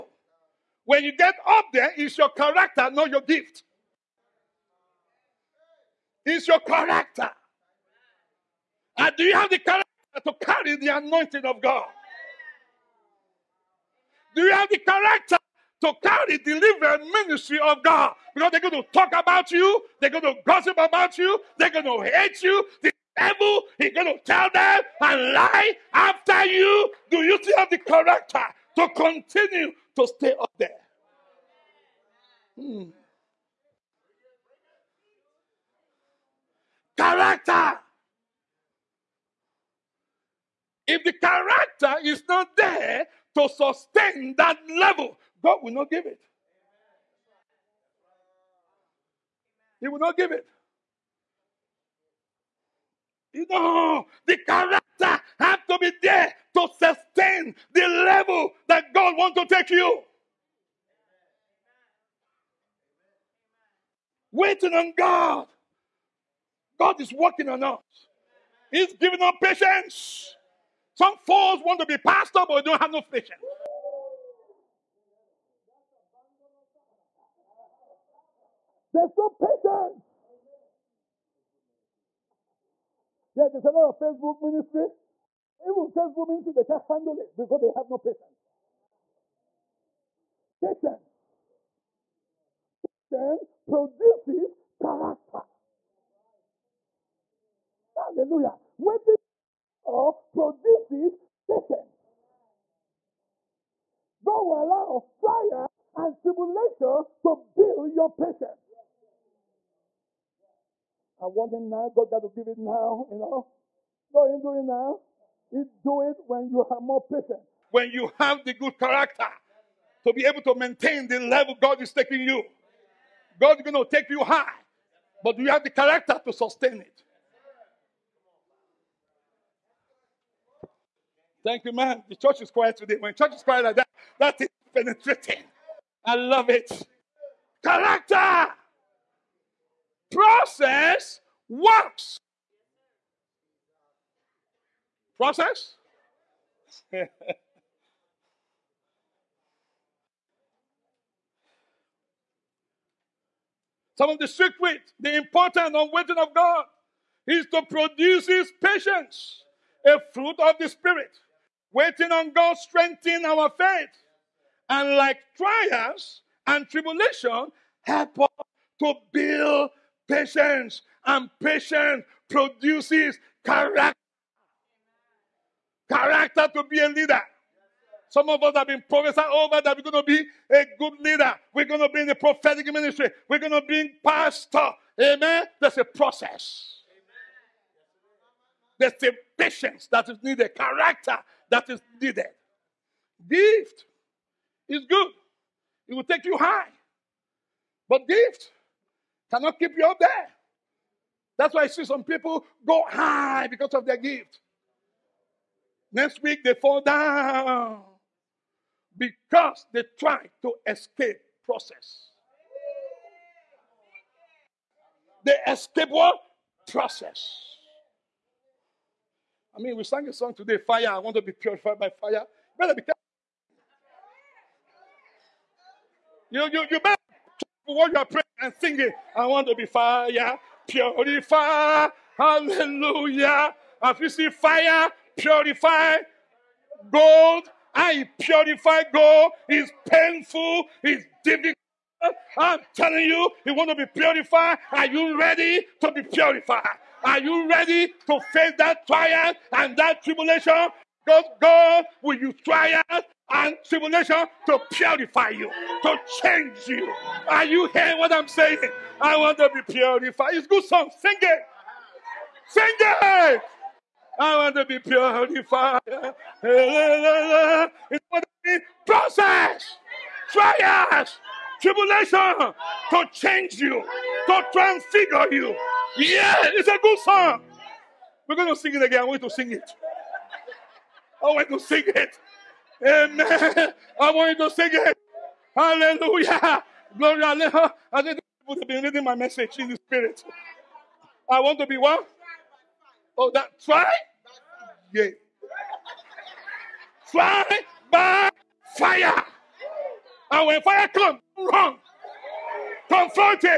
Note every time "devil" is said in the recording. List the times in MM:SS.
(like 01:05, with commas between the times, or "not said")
00:23.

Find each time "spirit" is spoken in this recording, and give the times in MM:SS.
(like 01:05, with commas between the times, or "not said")
02:40, 04:49.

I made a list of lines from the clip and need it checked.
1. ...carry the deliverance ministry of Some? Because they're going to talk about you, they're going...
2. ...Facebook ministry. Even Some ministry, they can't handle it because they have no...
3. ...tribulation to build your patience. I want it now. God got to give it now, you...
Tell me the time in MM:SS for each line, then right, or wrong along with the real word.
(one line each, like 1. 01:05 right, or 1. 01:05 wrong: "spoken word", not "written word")
1. 00:16 wrong: "God", not "Some"
2. 01:23 wrong: "Facebook", not "Some"
3. 01:46 right.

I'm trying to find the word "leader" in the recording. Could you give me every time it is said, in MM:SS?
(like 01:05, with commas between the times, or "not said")
02:56, 03:00.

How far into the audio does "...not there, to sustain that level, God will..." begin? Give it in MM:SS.
00:42.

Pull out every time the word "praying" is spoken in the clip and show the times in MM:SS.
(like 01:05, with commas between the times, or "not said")
03:48.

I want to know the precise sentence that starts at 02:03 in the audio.
God is going to take you high, but you have the character to sustain it.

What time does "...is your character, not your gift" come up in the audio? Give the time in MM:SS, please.
00:01.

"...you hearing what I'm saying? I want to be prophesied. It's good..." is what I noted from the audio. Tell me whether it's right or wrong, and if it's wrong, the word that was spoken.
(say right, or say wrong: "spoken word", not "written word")
wrong: "purified", not "prophesied".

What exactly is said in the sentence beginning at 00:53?
You know, the character have to be there to sustain the level that God wants to take you.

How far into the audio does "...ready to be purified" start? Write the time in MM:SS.
04:05.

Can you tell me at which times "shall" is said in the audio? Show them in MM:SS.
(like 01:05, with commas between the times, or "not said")
not said.